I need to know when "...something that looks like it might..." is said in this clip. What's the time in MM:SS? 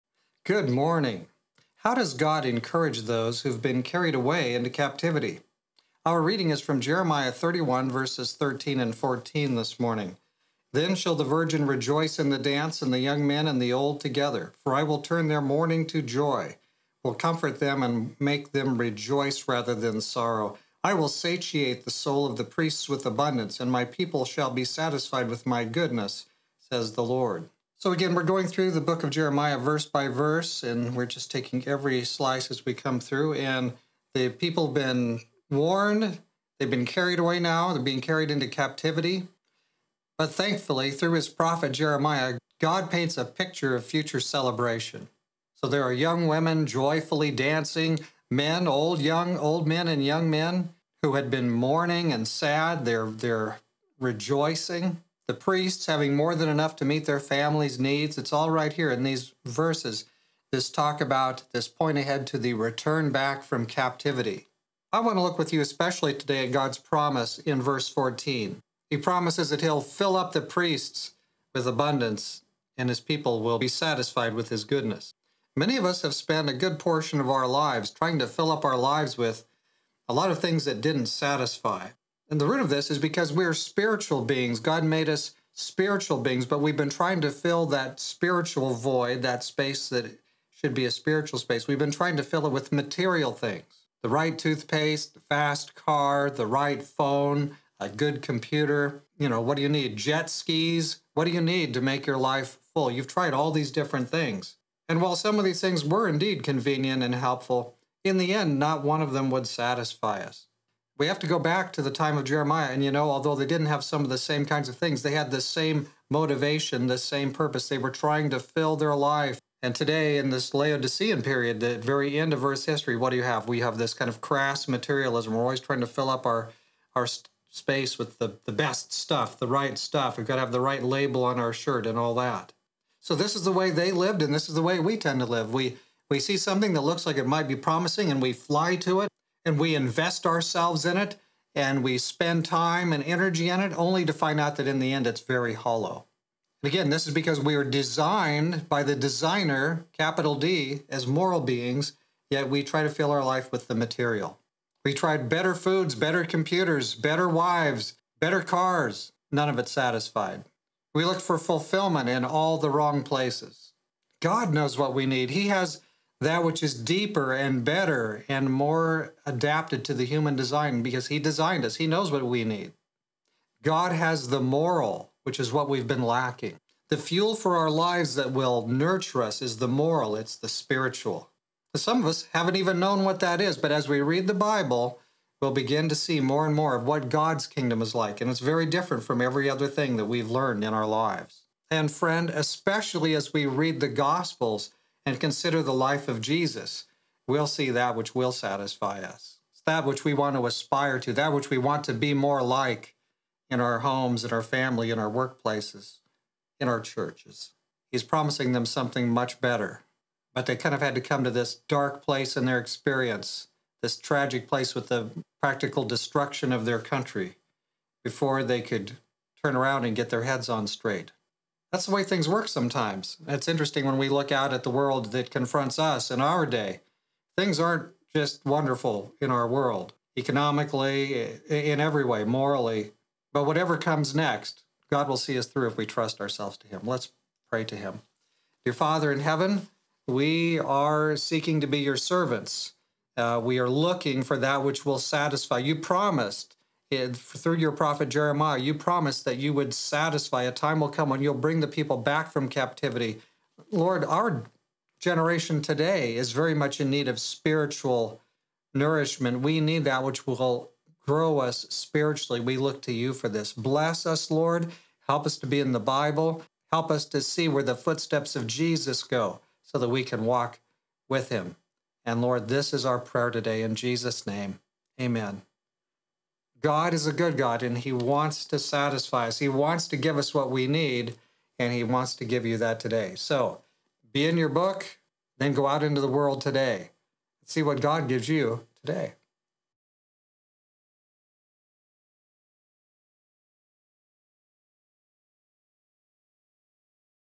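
02:16.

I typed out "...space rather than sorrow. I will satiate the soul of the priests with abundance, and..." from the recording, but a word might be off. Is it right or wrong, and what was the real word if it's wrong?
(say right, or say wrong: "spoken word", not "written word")
wrong: "rejoice", not "space".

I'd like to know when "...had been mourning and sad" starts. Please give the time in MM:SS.
00:51.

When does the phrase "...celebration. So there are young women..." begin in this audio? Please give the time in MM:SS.
00:44.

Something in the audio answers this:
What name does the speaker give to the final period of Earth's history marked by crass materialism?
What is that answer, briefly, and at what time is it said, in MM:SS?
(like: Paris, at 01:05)
Laodicean, at 02:00.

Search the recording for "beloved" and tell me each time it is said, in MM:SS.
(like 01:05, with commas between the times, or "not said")
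not said.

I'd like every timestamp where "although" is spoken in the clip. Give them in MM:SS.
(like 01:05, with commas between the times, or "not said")
01:53.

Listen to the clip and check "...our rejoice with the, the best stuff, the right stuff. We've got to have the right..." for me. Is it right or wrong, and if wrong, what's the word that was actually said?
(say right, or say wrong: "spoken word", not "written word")
wrong: "space", not "rejoice".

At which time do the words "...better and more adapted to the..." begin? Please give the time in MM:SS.
02:47.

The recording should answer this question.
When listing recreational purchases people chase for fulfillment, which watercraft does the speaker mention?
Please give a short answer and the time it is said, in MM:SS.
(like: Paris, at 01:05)
Jet skis, at 01:39.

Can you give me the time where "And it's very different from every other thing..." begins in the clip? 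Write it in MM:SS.
03:08.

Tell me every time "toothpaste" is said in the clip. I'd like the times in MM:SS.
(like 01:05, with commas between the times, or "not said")
01:34.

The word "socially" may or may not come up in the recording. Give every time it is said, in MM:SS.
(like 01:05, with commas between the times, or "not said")
not said.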